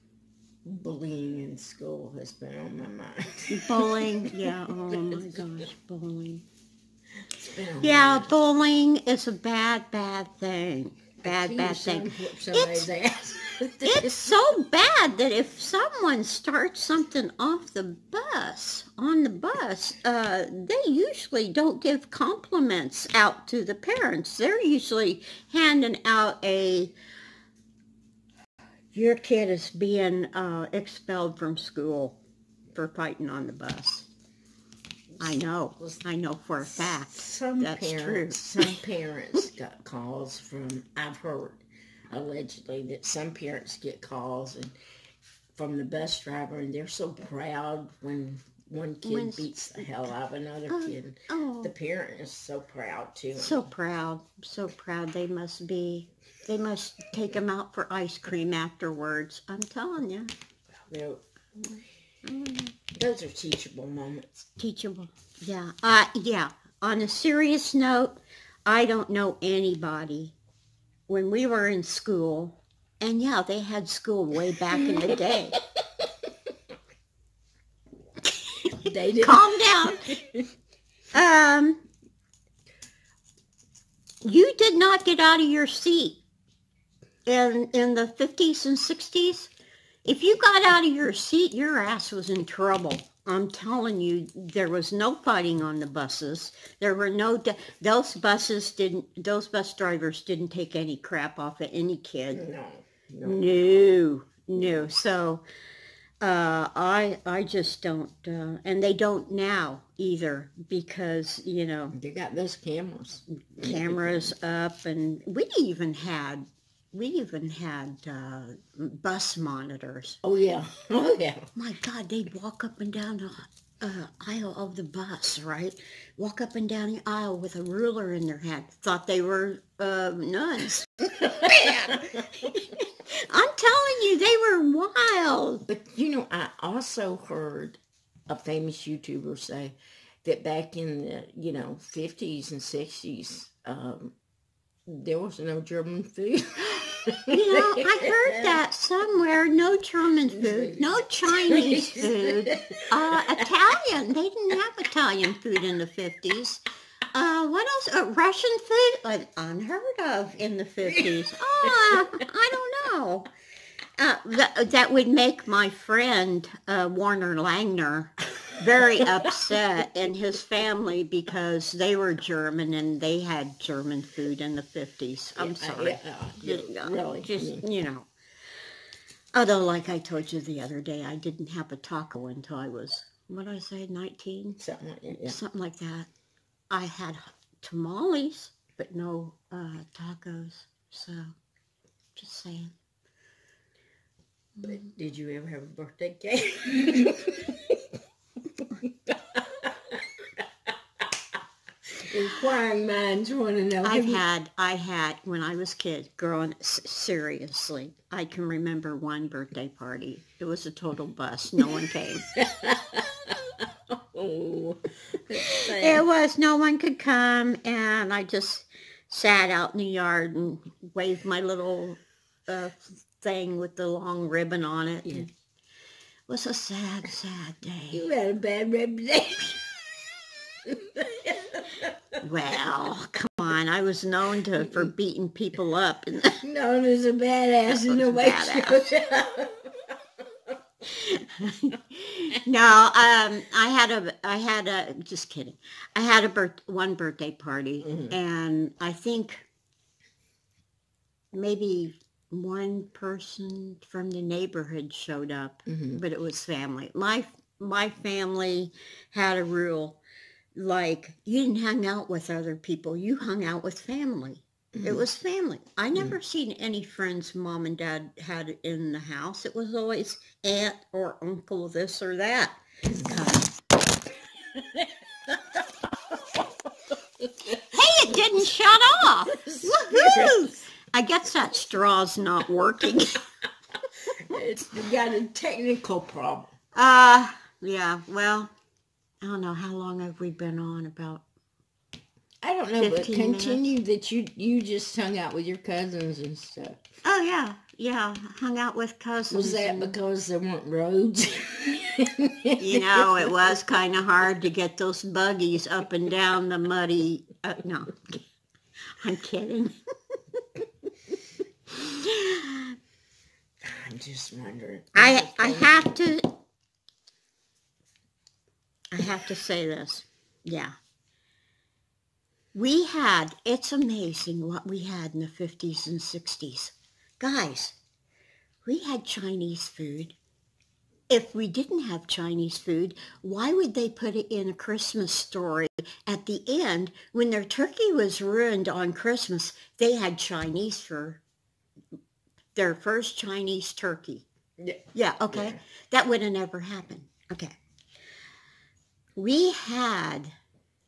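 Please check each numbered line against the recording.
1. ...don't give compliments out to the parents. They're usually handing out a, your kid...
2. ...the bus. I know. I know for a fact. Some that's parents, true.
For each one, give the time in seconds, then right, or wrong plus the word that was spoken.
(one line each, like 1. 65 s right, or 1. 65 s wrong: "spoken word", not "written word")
1. 21 s right
2. 33 s right.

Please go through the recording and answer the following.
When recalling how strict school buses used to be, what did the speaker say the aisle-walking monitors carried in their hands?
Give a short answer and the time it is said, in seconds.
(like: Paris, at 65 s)
a ruler, at 127 s.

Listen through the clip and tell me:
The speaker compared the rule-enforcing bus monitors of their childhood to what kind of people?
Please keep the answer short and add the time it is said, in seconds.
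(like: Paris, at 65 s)
nuns, at 130 s.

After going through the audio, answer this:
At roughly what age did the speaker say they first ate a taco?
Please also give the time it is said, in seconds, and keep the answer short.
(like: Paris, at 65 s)
19, at 183 s.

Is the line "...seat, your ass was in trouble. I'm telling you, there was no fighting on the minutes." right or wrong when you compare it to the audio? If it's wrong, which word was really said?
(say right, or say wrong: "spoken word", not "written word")
wrong: "buses", not "minutes".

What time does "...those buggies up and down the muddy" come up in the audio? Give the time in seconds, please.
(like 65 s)
304 s.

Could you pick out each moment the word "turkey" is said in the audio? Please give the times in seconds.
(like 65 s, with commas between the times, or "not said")
337 s, 343 s.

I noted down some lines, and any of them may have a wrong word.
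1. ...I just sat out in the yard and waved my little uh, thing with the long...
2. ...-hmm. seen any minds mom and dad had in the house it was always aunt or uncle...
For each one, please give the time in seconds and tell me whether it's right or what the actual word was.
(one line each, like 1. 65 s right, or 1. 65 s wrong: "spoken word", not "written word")
1. 218 s right
2. 266 s wrong: "friends", not "minds".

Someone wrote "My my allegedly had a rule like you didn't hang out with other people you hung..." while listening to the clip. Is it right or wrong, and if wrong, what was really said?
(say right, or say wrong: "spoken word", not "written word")
wrong: "family", not "allegedly".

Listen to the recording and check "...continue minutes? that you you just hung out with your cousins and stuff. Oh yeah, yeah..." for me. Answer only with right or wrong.
right.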